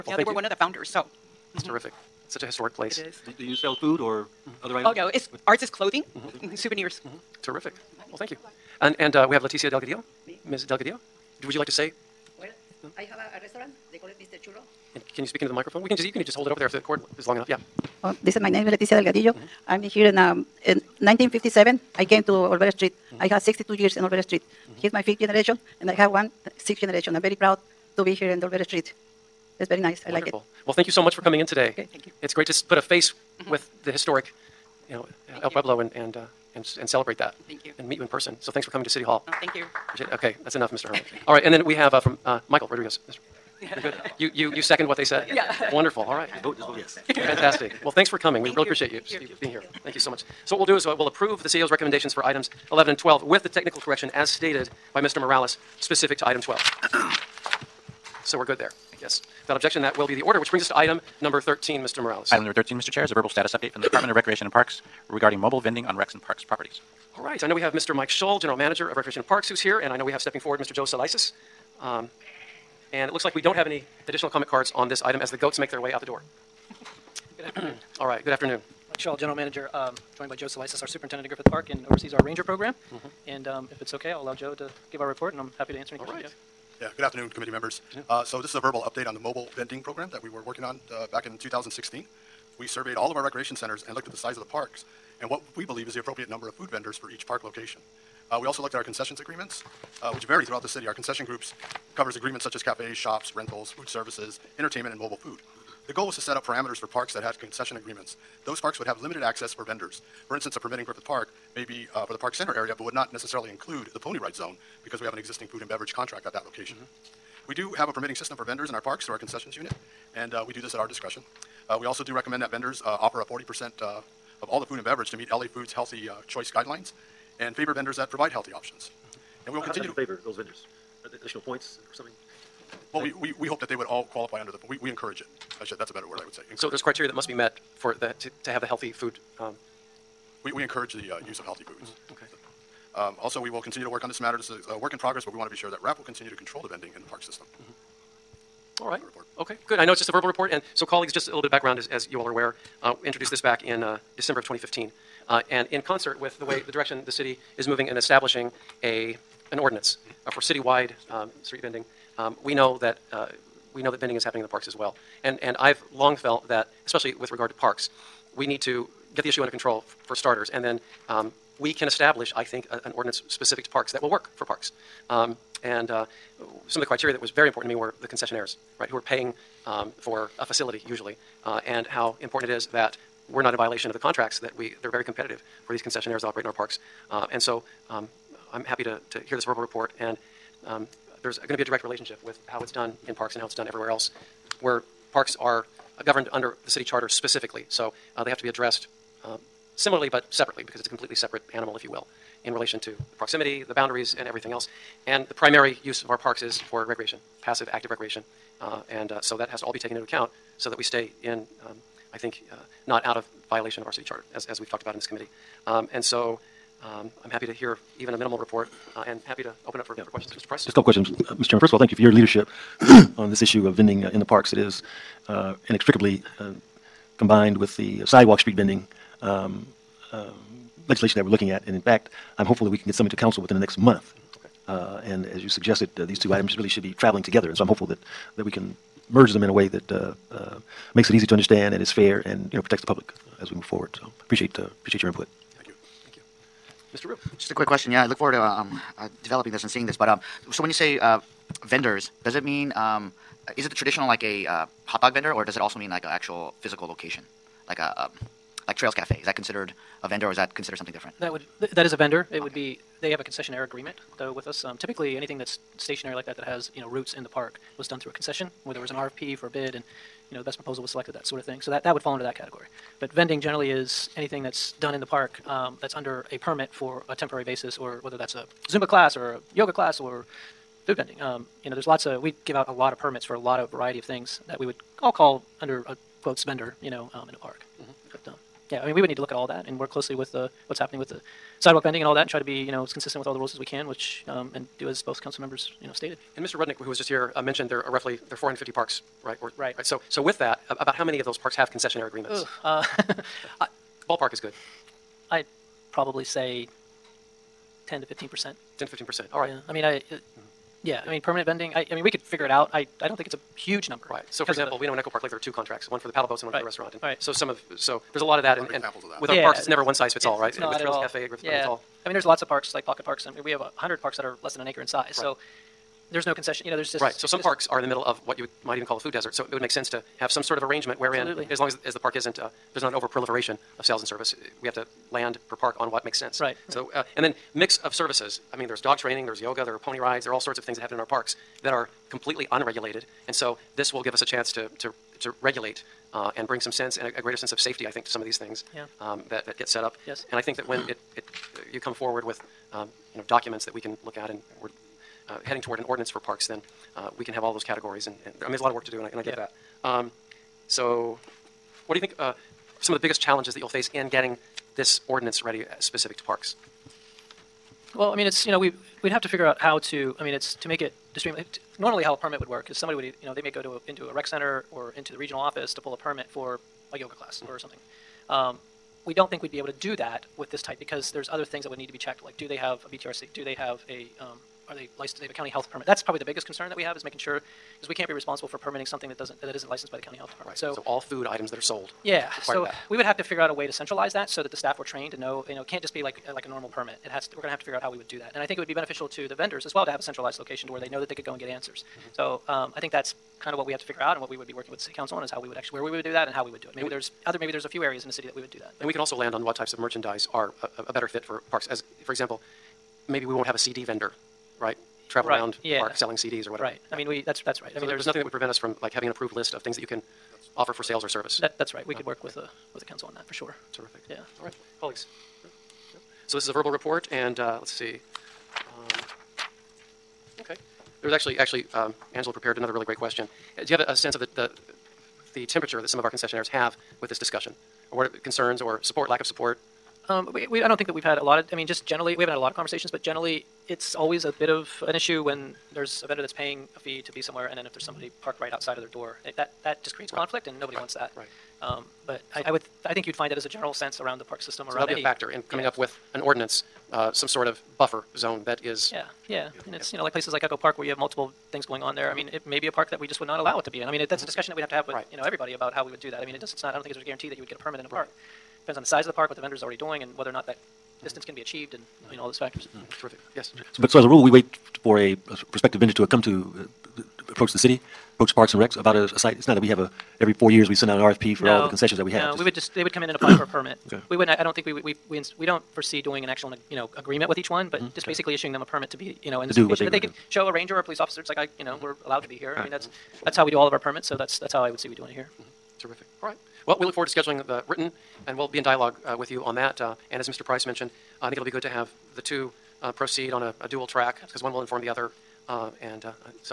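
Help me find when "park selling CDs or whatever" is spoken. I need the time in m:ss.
6:55.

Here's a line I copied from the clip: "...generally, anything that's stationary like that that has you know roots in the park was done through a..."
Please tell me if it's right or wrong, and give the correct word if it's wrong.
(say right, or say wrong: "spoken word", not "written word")
wrong: "typically", not "generally".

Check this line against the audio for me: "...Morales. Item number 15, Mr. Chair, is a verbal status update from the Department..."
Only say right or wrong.
wrong.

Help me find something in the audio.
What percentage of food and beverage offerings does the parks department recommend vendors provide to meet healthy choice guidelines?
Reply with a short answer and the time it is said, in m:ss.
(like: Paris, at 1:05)
40%, at 2:03.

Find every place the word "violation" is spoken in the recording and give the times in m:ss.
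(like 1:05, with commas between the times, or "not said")
3:03, 3:33.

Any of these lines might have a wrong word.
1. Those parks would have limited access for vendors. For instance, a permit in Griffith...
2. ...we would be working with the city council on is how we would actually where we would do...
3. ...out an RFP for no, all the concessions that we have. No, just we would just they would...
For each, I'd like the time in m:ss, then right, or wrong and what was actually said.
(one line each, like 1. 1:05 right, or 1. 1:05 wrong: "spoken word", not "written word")
1. 1:48 right
2. 6:44 right
3. 8:00 right.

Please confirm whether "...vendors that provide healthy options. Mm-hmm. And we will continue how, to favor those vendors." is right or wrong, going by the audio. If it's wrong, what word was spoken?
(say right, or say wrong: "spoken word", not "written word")
right.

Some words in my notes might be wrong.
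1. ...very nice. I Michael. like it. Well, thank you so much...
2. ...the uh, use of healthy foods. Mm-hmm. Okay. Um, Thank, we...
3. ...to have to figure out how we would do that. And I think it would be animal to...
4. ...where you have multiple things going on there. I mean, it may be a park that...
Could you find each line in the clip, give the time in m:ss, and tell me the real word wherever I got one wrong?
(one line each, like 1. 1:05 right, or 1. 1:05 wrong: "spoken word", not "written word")
1. 0:29 wrong: "Wonderful", not "Michael"
2. 2:20 wrong: "Also", not "Thank"
3. 6:37 wrong: "beneficial", not "animal"
4. 7:40 right.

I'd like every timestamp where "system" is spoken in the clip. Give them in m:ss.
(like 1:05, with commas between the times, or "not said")
1:58, 2:27, 7:34.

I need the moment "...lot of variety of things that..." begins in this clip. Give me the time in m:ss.
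4:43.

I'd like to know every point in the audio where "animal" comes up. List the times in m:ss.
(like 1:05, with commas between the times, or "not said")
3:21.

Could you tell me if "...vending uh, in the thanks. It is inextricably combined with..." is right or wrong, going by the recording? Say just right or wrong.
wrong.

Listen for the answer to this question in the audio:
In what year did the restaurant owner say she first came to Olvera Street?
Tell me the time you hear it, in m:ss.
0:20.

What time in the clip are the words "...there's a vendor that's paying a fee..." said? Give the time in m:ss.
7:25.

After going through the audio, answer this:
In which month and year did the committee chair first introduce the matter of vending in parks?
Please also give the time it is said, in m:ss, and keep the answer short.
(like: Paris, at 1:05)
December 2015, at 2:34.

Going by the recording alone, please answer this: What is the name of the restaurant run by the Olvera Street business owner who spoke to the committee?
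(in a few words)
Mr. Churro.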